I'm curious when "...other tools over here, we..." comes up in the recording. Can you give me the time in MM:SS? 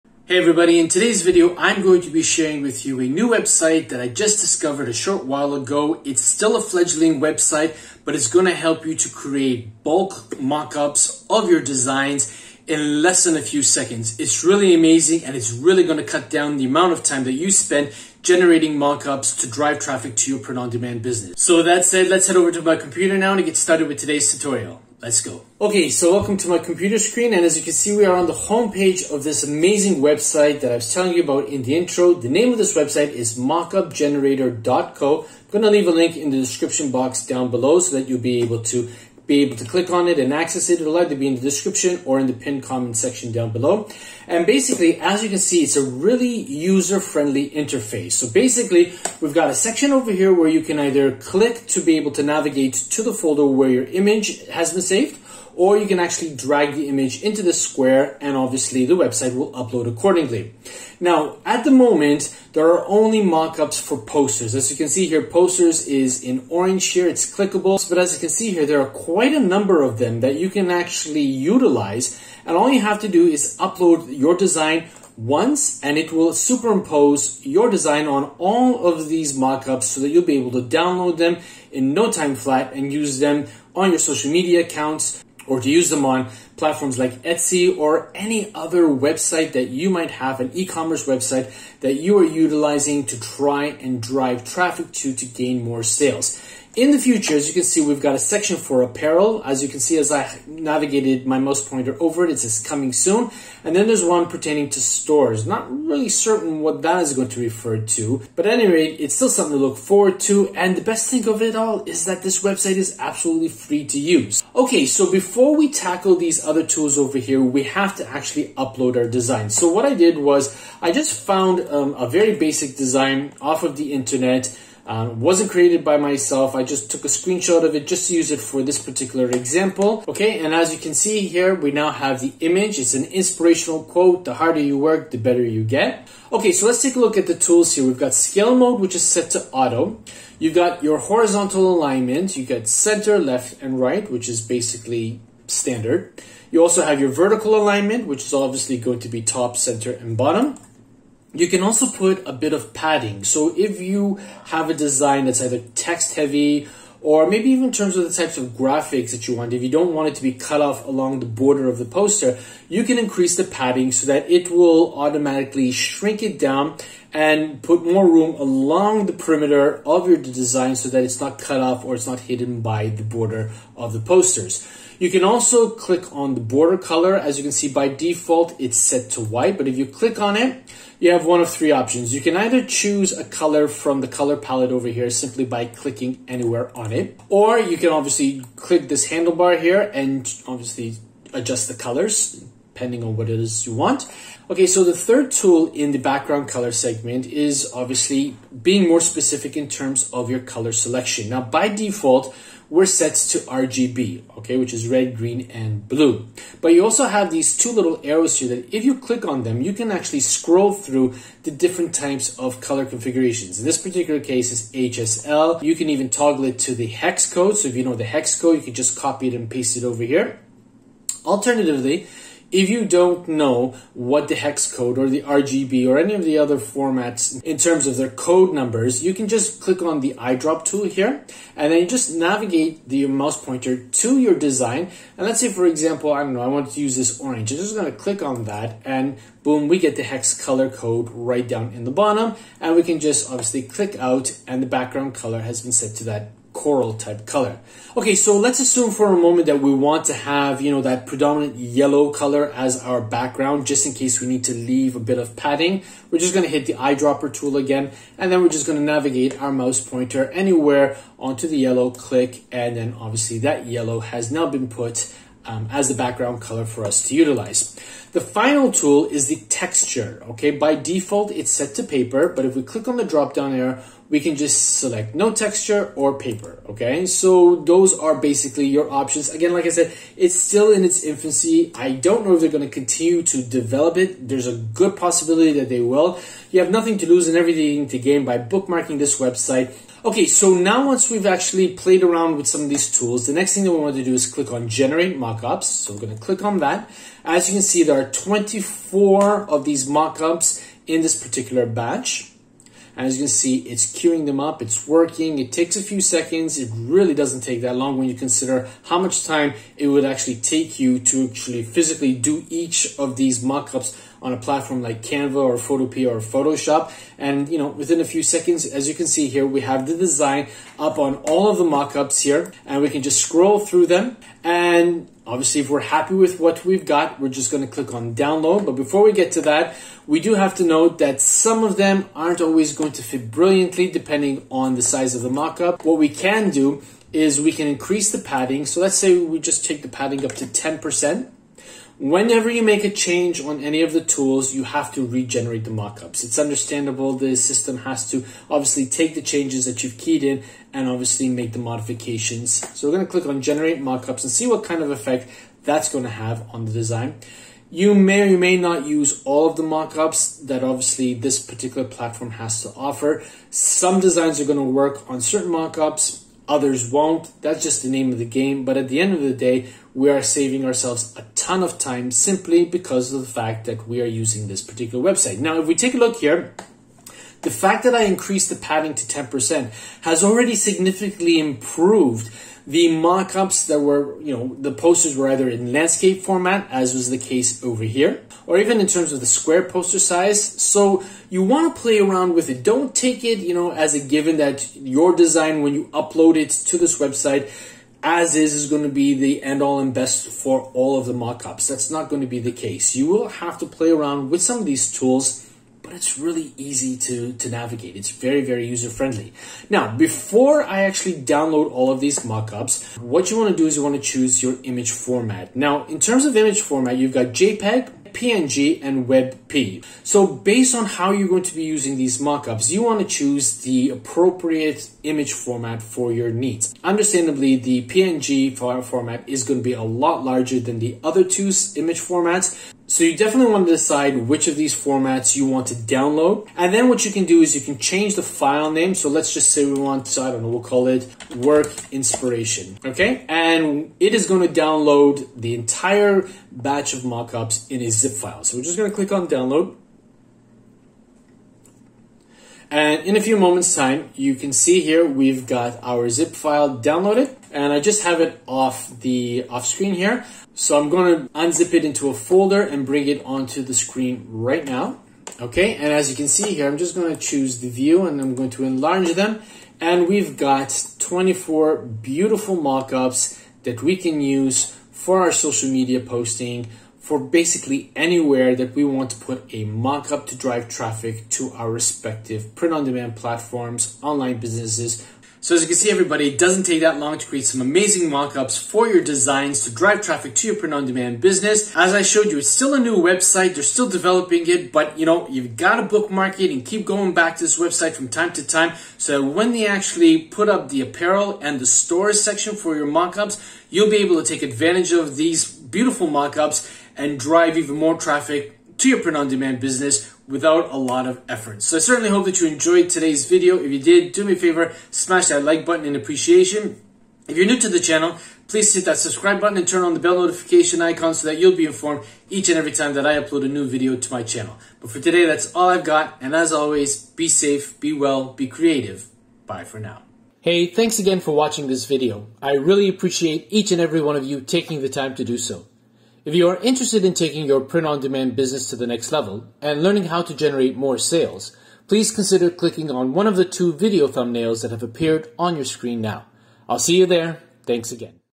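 01:56.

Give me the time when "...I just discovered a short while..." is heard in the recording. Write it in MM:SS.
00:03.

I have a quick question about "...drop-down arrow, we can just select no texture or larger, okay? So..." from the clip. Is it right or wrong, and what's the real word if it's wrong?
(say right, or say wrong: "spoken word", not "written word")
wrong: "paper", not "larger".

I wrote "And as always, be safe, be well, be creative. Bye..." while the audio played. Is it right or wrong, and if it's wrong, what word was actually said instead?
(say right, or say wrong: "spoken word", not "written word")
right.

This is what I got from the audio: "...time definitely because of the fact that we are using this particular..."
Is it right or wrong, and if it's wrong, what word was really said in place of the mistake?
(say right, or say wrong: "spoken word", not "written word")
wrong: "simply", not "definitely".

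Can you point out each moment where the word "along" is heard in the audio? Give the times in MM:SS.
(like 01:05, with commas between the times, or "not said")
02:40, 02:48.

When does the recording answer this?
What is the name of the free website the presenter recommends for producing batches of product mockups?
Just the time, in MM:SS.
00:33.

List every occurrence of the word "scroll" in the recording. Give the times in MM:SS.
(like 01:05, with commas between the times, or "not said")
03:30, 05:23.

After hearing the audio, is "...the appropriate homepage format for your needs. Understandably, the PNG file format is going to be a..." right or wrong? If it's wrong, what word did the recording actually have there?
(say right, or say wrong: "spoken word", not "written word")
wrong: "image", not "homepage".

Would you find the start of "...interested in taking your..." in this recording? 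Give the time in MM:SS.
08:56.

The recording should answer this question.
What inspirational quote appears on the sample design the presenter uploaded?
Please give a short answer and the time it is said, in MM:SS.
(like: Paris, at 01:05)
The harder you work, the better you get, at 02:14.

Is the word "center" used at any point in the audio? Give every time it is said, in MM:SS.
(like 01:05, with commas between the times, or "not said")
02:22, 02:29.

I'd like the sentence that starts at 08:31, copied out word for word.
So I certainly hope that you enjoyed today's video.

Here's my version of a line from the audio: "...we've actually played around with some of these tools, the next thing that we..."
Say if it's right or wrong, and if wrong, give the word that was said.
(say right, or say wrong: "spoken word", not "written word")
right.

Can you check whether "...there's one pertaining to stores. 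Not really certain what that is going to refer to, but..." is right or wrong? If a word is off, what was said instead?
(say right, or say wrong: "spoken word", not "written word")
right.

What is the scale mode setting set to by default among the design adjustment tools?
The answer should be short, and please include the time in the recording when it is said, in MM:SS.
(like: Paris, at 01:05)
Auto, at 02:19.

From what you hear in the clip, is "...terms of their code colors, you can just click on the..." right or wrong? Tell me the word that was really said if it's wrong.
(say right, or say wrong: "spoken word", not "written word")
wrong: "numbers", not "colors".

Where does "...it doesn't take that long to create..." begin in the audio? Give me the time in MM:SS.
08:06.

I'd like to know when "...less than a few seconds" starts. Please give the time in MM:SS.
00:13.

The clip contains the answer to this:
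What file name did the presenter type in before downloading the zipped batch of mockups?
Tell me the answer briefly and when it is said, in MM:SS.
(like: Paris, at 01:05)
work inspiration, at 07:21.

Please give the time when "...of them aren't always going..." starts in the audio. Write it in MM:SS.
05:31.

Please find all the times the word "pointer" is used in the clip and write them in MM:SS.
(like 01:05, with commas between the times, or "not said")
01:41, 03:53, 04:19.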